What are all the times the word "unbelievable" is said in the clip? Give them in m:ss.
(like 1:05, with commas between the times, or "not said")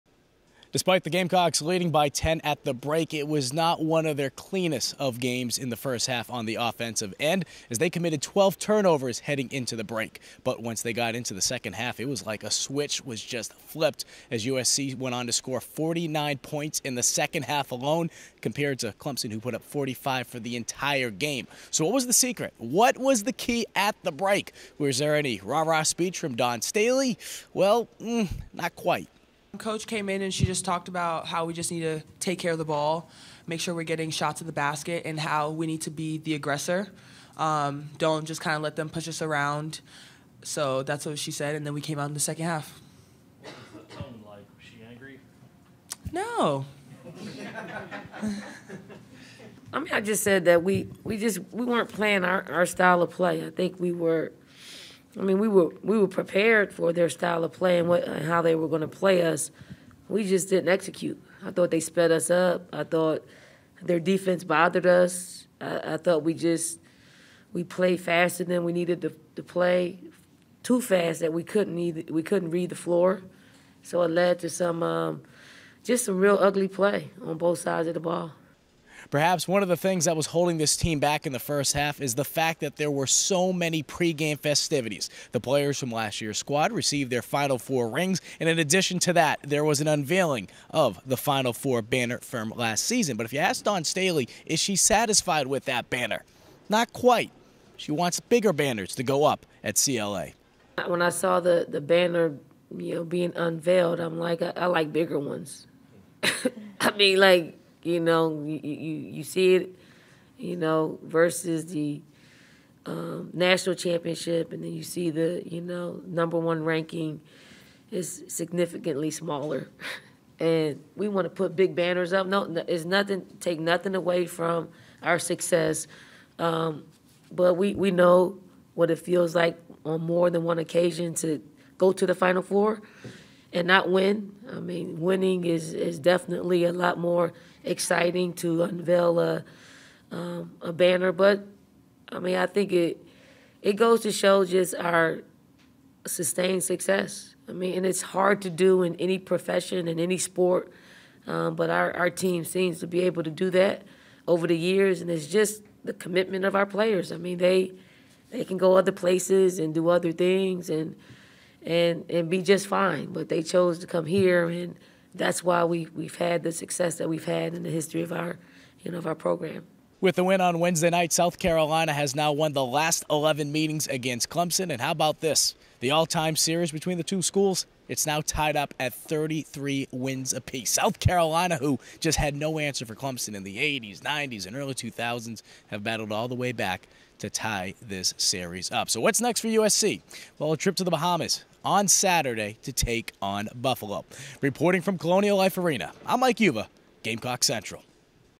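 not said.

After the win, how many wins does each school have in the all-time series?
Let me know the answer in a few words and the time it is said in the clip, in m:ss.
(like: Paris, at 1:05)
33, at 2:58.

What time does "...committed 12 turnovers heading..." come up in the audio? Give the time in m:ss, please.
0:07.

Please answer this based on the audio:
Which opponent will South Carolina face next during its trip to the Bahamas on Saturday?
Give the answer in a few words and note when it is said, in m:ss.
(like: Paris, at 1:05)
Buffalo, at 3:13.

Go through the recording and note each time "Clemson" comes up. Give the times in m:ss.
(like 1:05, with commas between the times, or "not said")
0:18, 2:54, 3:02.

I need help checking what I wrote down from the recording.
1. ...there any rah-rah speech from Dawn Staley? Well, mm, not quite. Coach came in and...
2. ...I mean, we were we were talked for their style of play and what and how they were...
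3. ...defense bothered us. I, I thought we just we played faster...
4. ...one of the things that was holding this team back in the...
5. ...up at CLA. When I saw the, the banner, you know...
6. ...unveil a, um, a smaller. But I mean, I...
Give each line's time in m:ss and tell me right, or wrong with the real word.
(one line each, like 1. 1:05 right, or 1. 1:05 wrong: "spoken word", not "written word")
1. 0:24 right
2. 0:55 wrong: "prepared", not "talked"
3. 1:03 right
4. 1:19 right
5. 1:39 right
6. 2:18 wrong: "banner", not "smaller".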